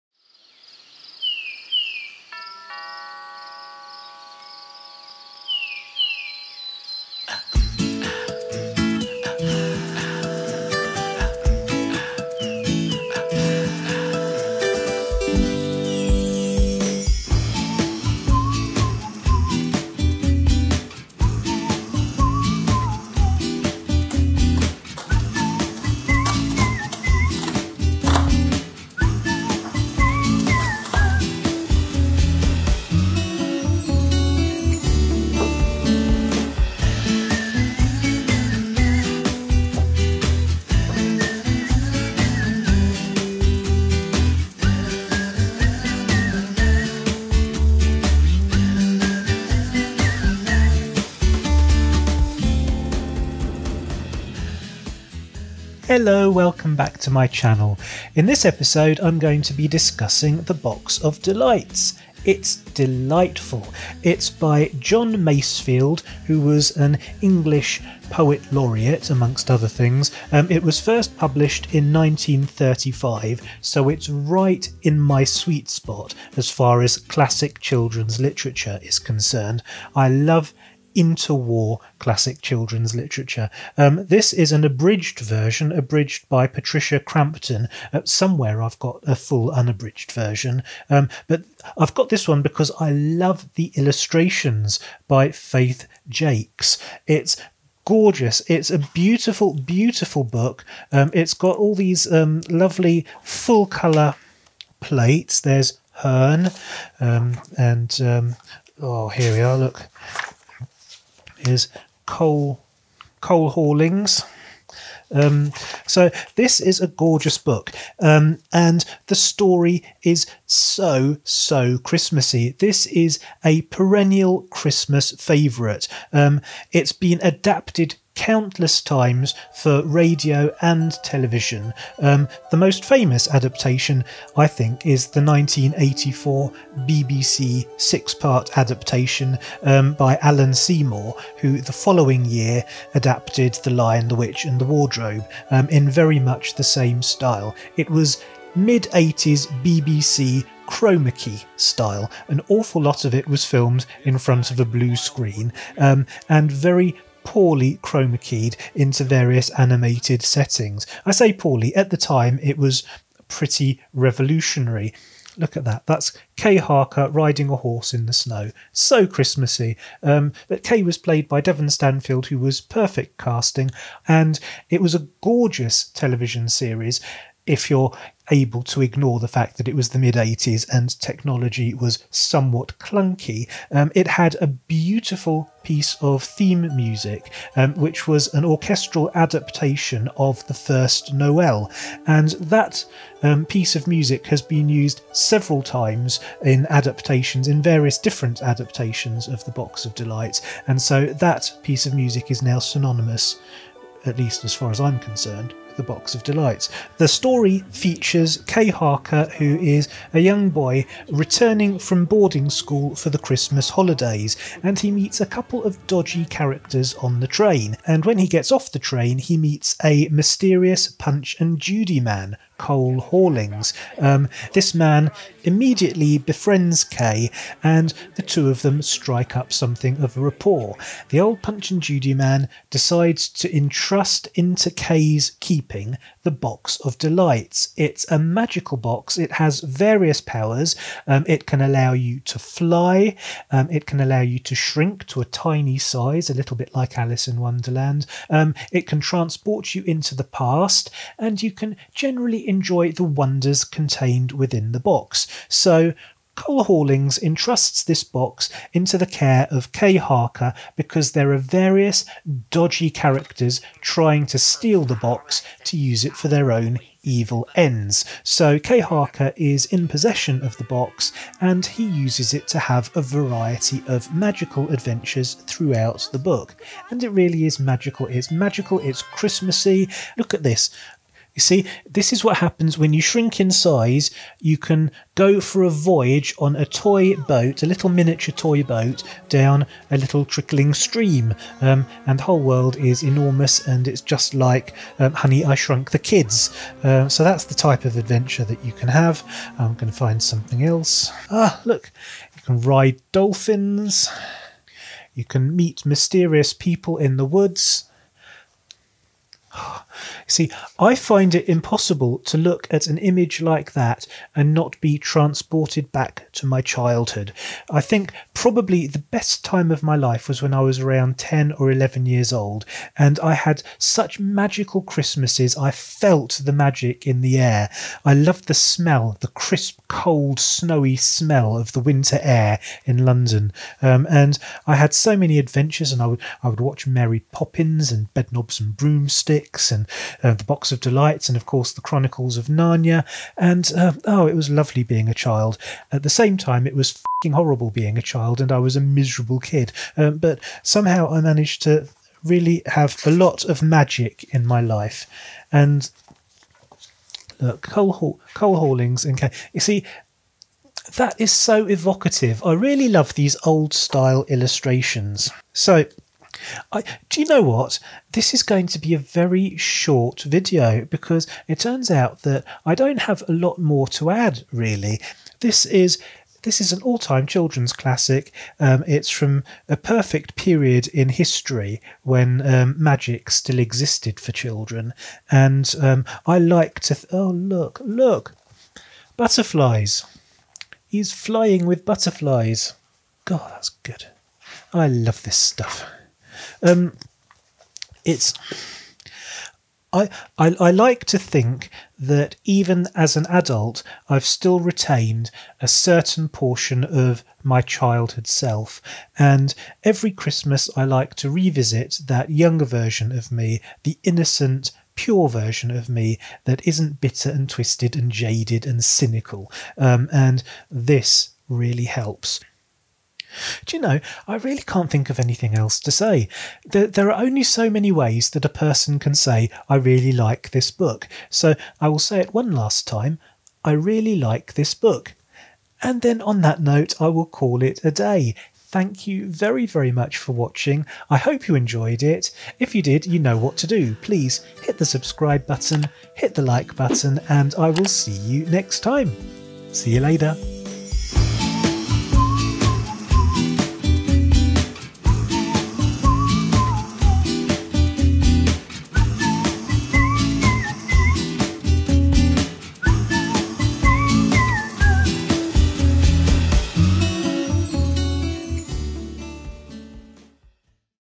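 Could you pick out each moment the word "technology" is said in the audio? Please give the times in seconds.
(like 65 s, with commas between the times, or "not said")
181 s.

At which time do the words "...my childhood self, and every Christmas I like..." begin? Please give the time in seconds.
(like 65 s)
407 s.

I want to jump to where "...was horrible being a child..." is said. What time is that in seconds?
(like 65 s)
346 s.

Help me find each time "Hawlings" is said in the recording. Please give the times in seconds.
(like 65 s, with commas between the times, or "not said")
113 s, 222 s, 256 s, 358 s.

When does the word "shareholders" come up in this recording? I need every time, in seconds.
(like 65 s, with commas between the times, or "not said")
not said.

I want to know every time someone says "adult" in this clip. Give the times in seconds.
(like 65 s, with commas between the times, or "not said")
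403 s.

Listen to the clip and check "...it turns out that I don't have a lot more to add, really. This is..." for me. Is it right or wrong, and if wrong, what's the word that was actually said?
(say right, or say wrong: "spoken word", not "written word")
right.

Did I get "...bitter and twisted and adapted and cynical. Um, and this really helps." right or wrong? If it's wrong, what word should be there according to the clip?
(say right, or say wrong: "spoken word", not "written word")
wrong: "jaded", not "adapted".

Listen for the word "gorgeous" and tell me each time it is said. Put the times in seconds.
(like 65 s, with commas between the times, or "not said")
97 s, 116 s, 175 s.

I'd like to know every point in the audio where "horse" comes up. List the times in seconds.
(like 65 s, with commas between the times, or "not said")
167 s.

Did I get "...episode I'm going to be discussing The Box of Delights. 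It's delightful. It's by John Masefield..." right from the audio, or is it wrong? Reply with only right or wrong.
right.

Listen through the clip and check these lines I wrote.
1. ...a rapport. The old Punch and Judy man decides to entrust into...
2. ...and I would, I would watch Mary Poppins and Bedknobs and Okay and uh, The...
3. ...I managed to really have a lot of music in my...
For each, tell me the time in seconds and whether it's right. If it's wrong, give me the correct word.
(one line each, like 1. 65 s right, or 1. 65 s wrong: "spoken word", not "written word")
1. 230 s right
2. 335 s wrong: "Broomsticks", not "Okay"
3. 351 s wrong: "magic", not "music".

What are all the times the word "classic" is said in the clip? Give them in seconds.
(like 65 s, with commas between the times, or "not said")
76 s, 81 s, 377 s.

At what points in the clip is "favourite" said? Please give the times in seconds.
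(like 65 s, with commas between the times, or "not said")
125 s.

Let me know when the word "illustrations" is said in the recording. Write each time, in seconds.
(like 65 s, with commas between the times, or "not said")
93 s, 364 s.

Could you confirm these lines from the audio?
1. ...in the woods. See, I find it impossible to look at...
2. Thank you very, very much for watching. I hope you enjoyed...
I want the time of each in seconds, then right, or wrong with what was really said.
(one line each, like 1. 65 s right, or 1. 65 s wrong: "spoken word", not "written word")
1. 306 s right
2. 438 s right.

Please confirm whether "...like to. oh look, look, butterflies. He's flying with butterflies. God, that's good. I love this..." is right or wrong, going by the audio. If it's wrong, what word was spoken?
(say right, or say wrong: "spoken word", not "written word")
right.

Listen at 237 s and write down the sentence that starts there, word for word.
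It's a magical box, it has various powers.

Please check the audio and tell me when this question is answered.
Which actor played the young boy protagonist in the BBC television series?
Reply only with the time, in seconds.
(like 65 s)
171 s.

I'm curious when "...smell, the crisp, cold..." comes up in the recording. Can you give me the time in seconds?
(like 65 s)
328 s.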